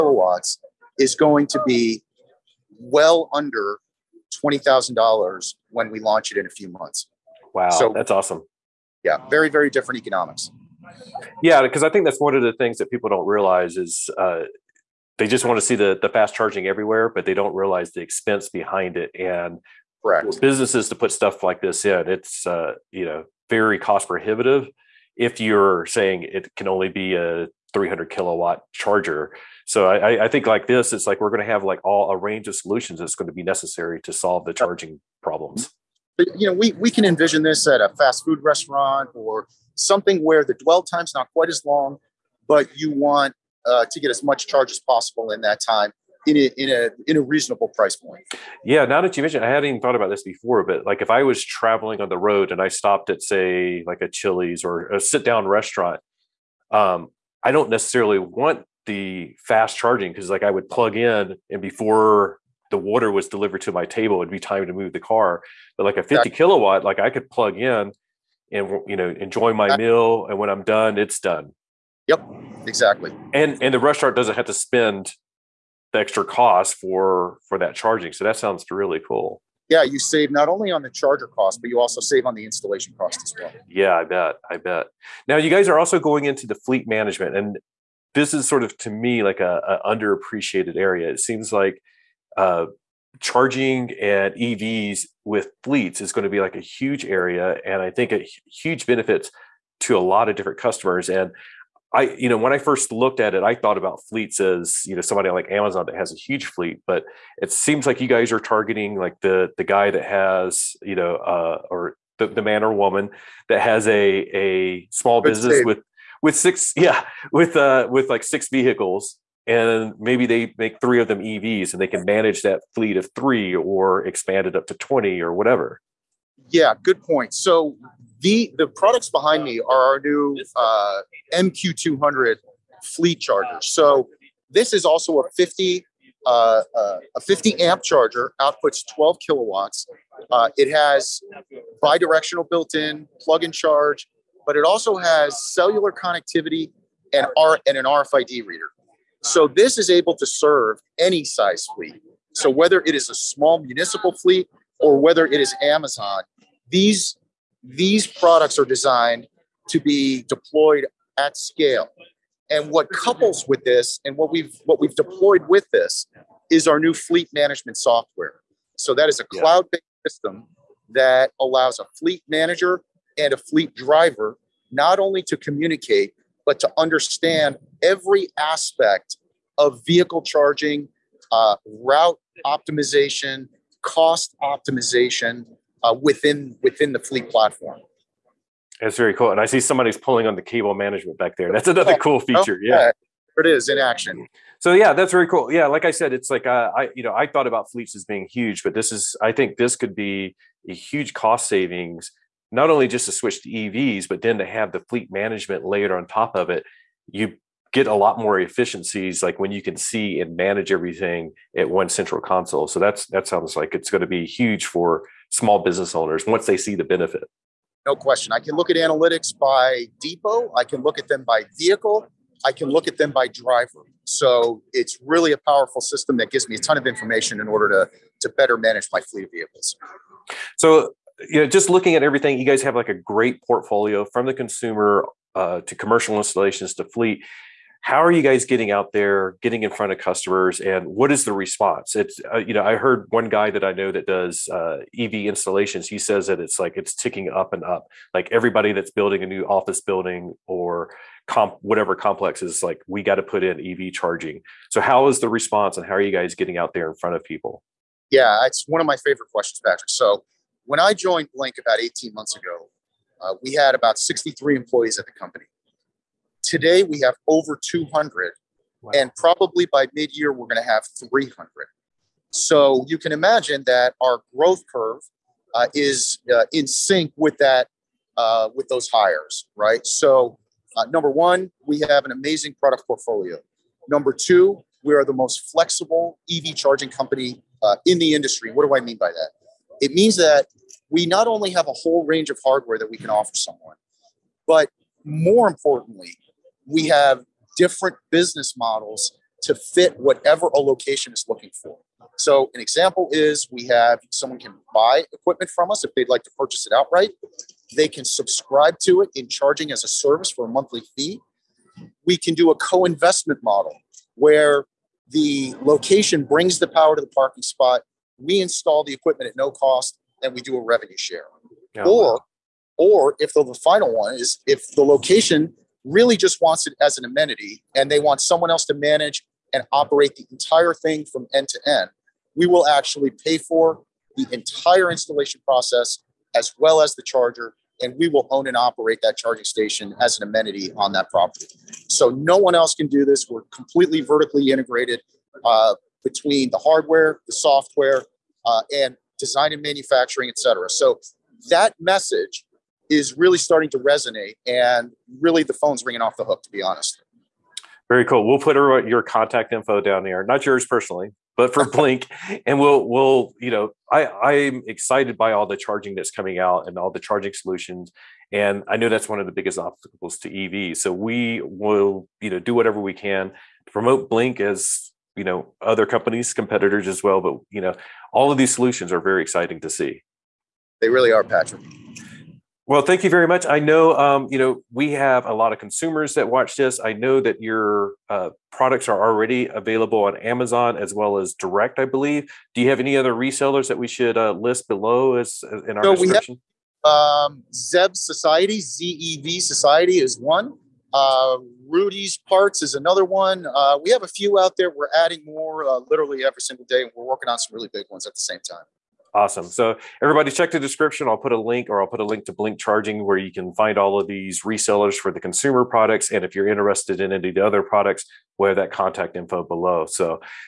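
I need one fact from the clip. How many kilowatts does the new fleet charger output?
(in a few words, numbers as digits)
12 kilowatts.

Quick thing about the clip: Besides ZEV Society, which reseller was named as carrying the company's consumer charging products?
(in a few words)
Rudy's Parts.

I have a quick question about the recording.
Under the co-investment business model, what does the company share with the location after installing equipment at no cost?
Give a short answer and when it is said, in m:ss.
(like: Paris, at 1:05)
revenue share, at 5:20.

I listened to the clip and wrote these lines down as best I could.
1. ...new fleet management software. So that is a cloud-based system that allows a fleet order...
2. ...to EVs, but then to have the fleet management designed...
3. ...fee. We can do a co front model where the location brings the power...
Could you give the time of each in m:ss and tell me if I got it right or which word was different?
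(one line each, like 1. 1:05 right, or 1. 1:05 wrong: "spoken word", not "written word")
1. 2:46 wrong: "manager", not "order"
2. 3:23 wrong: "layered", not "designed"
3. 5:10 wrong: "investment", not "front".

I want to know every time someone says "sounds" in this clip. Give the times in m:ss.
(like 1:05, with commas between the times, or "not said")
1:18, 3:33.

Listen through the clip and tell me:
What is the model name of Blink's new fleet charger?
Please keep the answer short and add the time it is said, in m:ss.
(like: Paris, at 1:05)
MQ200, at 2:11.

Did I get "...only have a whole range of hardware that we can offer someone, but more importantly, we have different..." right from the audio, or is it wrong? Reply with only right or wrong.
right.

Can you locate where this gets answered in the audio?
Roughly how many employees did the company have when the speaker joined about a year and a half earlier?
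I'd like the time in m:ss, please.
4:23.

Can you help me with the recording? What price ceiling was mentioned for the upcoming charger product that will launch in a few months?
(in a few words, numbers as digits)
$20,000.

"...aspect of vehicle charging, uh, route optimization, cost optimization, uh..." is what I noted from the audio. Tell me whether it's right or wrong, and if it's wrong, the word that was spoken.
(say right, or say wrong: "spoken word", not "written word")
right.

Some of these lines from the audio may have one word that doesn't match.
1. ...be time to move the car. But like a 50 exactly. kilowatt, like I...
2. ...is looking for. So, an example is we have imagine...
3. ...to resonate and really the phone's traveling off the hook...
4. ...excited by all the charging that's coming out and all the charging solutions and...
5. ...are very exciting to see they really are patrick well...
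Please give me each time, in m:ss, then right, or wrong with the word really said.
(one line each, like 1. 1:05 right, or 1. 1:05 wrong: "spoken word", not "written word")
1. 1:04 right
2. 5:01 wrong: "someone", not "imagine"
3. 5:53 wrong: "ringing", not "traveling"
4. 6:04 right
5. 6:18 right.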